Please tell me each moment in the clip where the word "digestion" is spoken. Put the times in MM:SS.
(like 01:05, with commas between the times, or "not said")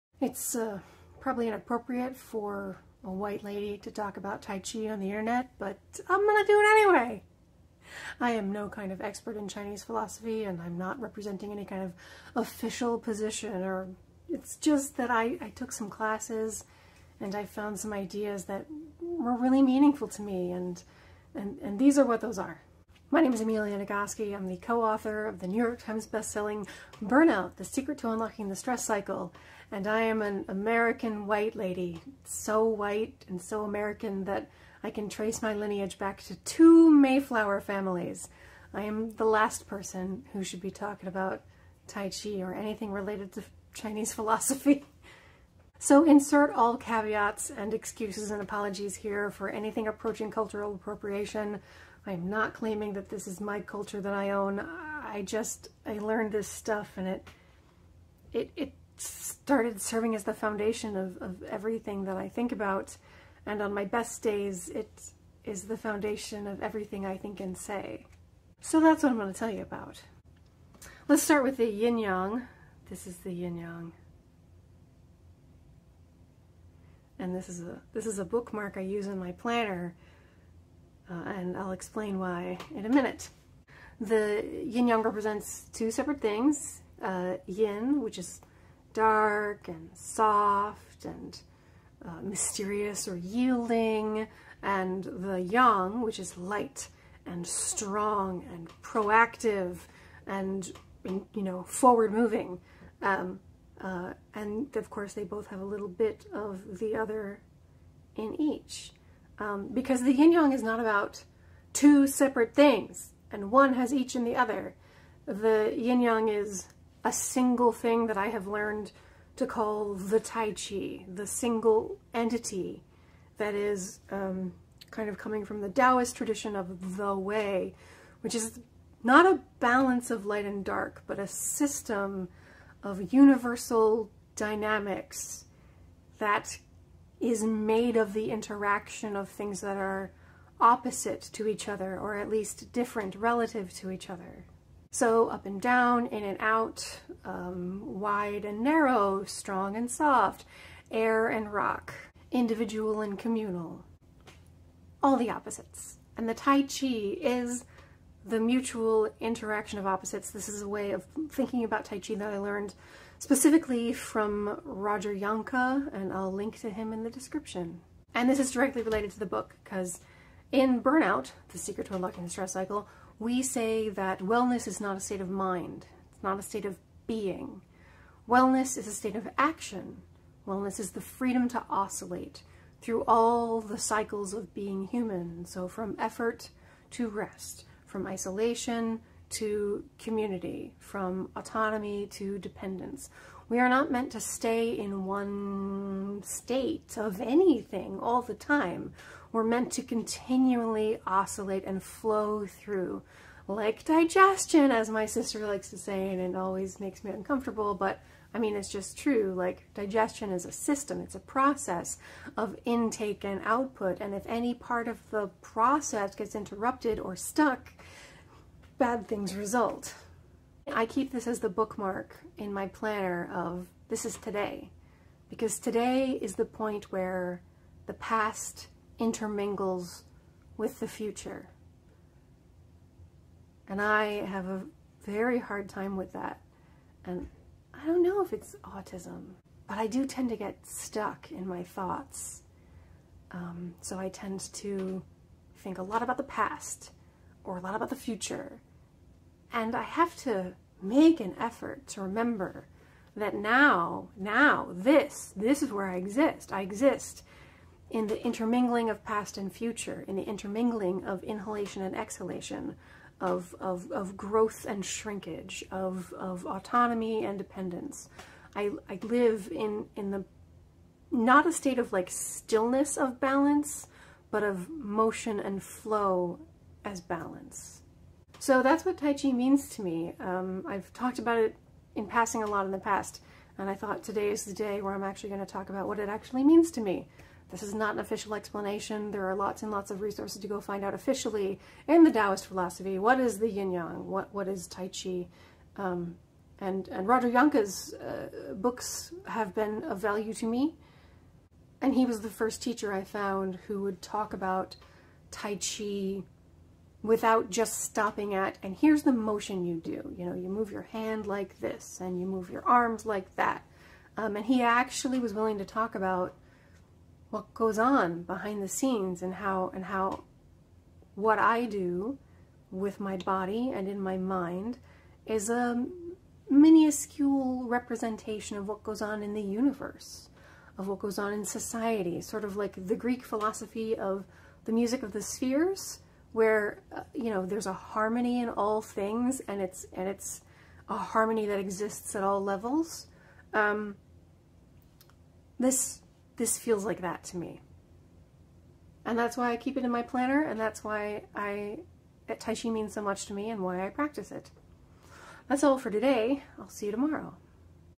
03:23, 03:29.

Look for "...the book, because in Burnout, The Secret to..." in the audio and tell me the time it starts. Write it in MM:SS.
02:49.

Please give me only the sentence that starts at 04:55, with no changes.
Um, and, and Roger Jahnke's uh, books have been of value to me.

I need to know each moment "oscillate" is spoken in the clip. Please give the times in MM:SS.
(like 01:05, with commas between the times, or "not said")
03:01, 03:21.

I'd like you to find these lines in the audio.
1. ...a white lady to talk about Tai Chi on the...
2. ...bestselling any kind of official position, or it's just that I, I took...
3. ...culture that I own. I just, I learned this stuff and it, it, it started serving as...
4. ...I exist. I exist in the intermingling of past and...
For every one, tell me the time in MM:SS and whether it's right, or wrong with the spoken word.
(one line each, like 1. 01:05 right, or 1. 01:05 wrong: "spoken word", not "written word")
1. 00:03 right
2. 00:10 wrong: "representing", not "bestselling"
3. 00:53 right
4. 04:15 right.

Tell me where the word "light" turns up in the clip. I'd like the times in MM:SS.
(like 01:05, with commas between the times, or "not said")
01:36, 02:10.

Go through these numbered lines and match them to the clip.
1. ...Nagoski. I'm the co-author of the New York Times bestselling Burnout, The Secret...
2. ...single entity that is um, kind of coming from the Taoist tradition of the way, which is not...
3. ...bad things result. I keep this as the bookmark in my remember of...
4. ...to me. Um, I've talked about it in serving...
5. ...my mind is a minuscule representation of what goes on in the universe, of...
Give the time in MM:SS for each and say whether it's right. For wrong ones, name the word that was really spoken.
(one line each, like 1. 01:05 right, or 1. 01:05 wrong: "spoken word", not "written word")
1. 00:23 right
2. 02:01 right
3. 03:38 wrong: "planner", not "remember"
4. 04:39 wrong: "passing", not "serving"
5. 05:23 right.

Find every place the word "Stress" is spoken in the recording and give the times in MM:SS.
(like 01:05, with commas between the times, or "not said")
00:28, 02:52.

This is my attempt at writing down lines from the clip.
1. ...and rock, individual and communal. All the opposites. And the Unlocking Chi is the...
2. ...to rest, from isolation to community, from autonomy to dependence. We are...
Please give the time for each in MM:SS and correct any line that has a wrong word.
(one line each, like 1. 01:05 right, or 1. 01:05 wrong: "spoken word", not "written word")
1. 02:31 wrong: "Tai", not "Unlocking"
2. 03:06 right.